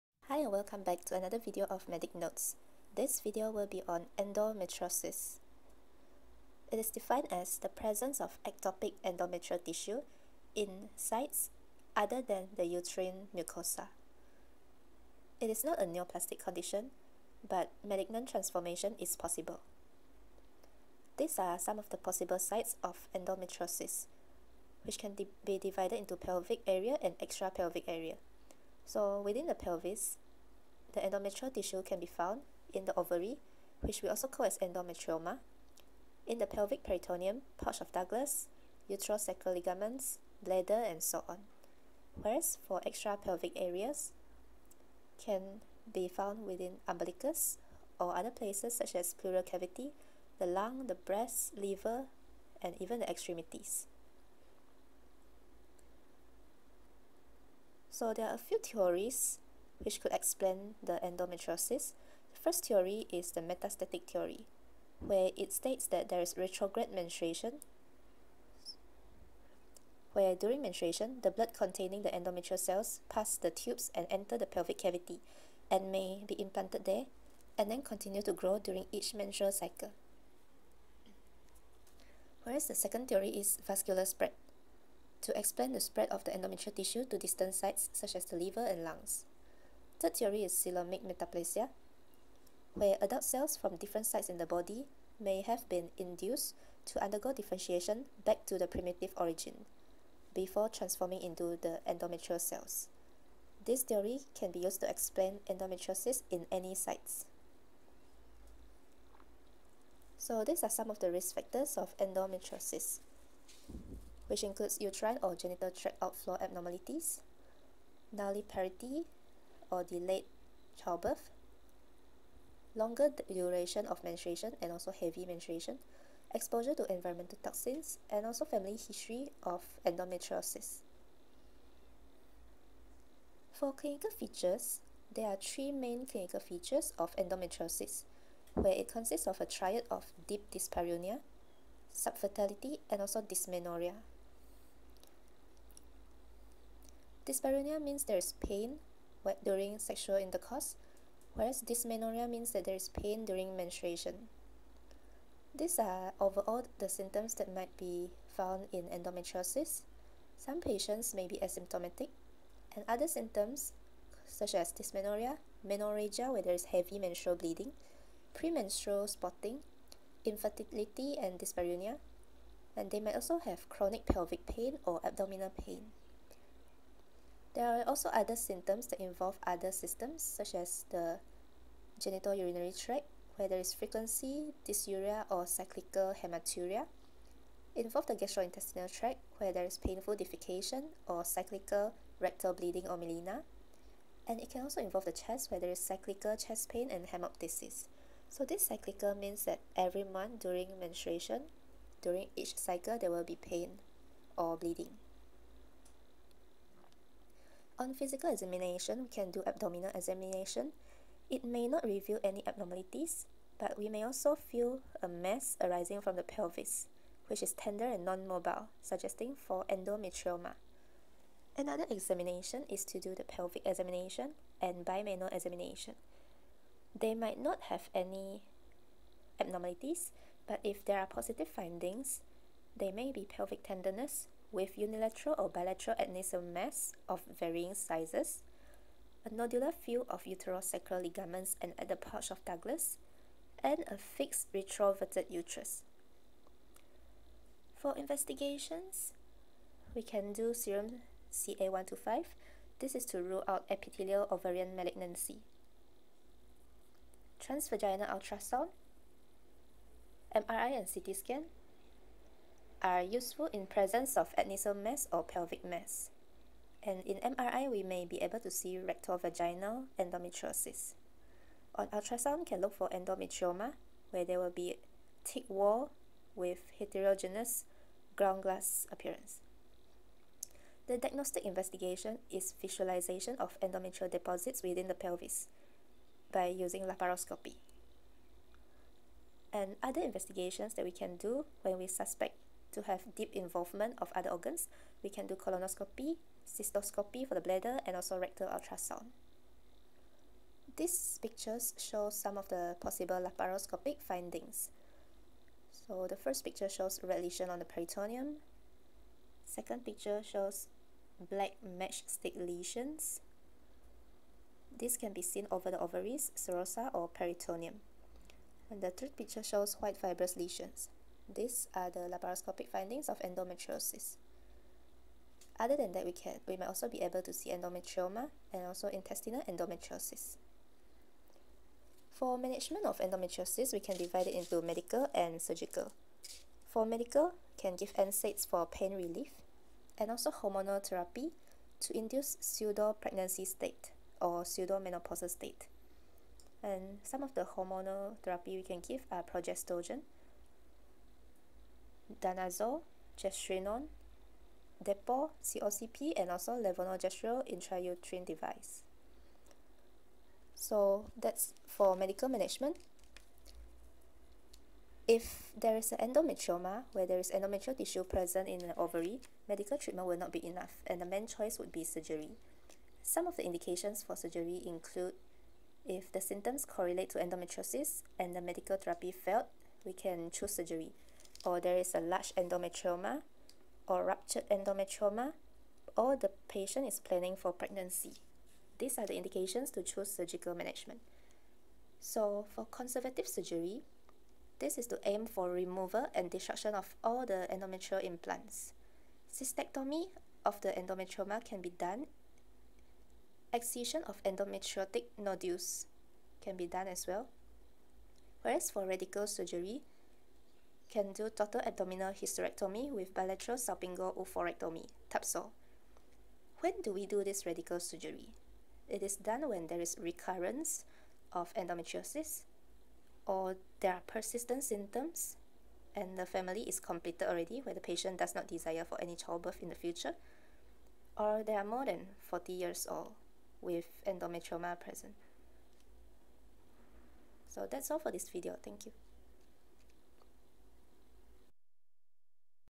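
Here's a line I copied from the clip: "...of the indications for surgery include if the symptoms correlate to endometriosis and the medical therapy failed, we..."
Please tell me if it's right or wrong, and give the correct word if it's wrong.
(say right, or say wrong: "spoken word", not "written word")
right.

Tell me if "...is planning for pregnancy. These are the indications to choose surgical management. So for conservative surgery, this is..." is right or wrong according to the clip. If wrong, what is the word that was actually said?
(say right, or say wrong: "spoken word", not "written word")
right.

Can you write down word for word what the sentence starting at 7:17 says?
So that's all for this video.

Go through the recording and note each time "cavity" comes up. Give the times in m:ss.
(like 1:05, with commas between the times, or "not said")
0:49, 1:14.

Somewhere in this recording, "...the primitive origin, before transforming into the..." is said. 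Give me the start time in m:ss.
1:38.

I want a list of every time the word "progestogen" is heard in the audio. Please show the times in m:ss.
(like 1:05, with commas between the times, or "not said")
5:49.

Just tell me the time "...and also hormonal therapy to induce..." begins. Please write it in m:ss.
5:39.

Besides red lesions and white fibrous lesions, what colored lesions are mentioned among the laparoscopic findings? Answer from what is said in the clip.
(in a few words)
Black matchstick lesions.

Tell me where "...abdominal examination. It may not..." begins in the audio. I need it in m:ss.
3:29.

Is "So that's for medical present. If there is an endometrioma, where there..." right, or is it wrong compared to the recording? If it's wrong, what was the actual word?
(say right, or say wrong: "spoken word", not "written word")
wrong: "management", not "present".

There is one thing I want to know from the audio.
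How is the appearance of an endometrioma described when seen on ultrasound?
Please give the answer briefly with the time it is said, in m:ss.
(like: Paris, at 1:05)
Heterogeneous ground glass, at 4:36.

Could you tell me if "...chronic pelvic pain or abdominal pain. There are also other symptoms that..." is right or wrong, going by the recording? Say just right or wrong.
right.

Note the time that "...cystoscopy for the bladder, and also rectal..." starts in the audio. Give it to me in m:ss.
4:56.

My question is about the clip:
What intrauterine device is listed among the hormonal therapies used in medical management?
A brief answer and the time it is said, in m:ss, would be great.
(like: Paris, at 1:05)
Levonorgestrel intrauterine device, at 5:56.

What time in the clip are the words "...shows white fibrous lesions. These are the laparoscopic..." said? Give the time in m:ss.
5:19.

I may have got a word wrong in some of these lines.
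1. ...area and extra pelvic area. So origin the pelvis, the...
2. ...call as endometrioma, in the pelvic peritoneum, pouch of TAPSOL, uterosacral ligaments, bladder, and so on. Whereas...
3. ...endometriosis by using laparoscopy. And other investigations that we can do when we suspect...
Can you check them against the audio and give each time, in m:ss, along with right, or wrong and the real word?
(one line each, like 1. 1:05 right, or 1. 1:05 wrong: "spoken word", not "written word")
1. 0:26 wrong: "within", not "origin"
2. 0:34 wrong: "Douglas", not "TAPSOL"
3. 4:44 wrong: "pelvis", not "endometriosis".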